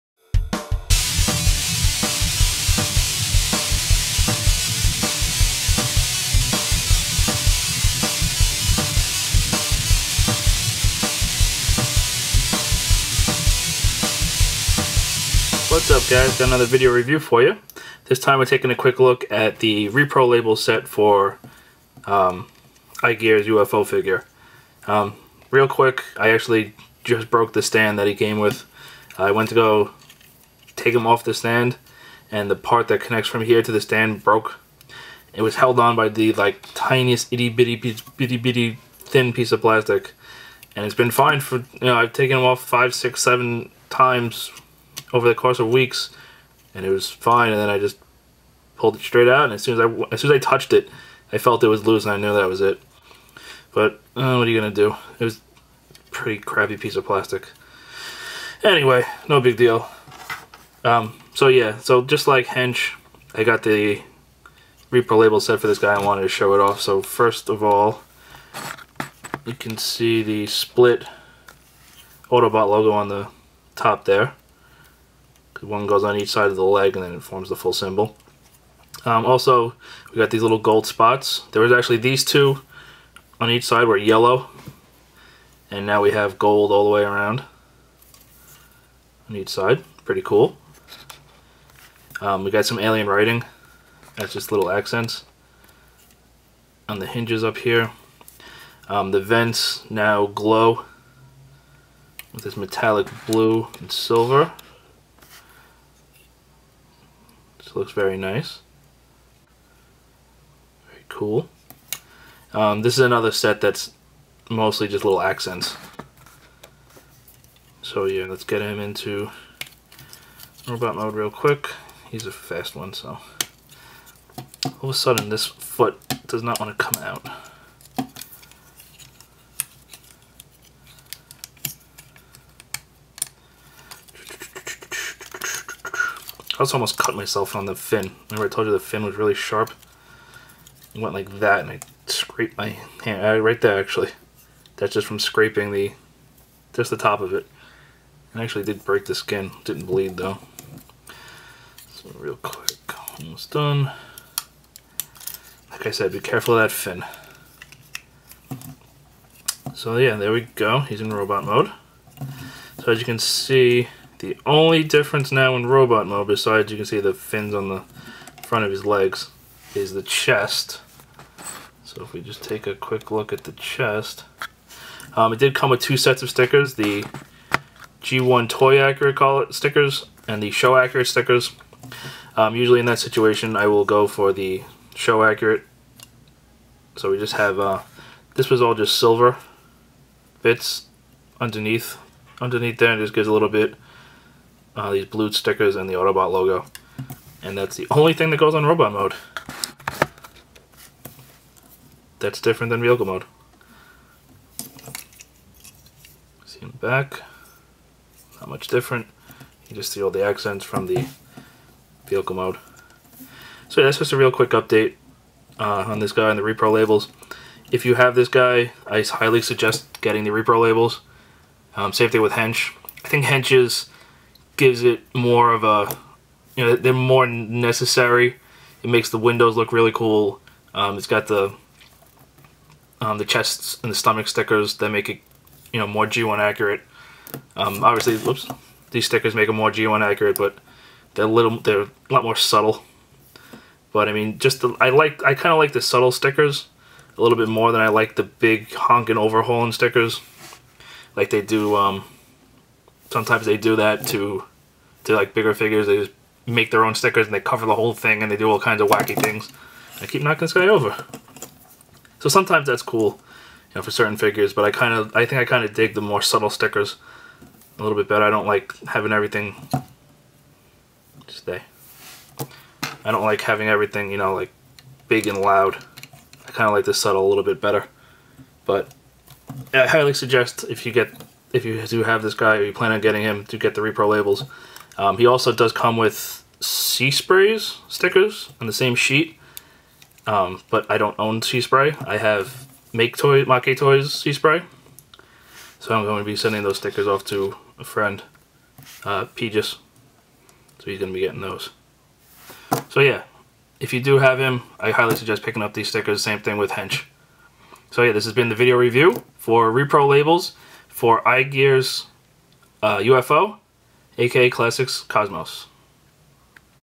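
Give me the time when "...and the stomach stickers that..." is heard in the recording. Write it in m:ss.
3:53.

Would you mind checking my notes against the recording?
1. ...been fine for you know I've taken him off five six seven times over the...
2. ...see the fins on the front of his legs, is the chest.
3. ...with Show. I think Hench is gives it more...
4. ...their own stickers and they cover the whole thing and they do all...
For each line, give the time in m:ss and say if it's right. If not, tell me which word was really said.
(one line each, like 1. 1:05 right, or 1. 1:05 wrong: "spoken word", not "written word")
1. 0:40 right
2. 2:46 right
3. 3:42 wrong: "Hench", not "Show"
4. 4:16 right.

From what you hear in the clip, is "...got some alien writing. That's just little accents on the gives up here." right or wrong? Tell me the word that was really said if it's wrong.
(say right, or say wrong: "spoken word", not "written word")
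wrong: "hinges", not "gives".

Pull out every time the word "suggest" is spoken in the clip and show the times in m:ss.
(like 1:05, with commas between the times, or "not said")
3:39, 4:40, 5:05.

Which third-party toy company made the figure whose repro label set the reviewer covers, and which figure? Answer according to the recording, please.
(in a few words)
iGear's UFO.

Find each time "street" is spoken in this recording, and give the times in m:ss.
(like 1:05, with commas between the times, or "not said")
not said.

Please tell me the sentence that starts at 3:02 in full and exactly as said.
Um, usually in that situation, I will go for the Show Accurate.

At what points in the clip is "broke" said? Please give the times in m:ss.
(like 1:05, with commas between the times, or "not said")
0:27, 0:34.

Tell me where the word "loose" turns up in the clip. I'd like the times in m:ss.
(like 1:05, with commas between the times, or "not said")
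0:51.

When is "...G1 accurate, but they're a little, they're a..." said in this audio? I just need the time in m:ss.
3:59.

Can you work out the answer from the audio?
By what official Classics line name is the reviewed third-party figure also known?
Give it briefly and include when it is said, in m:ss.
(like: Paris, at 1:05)
Classics Cosmos, at 5:14.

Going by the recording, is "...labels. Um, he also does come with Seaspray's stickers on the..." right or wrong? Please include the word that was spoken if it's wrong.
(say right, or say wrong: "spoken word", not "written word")
right.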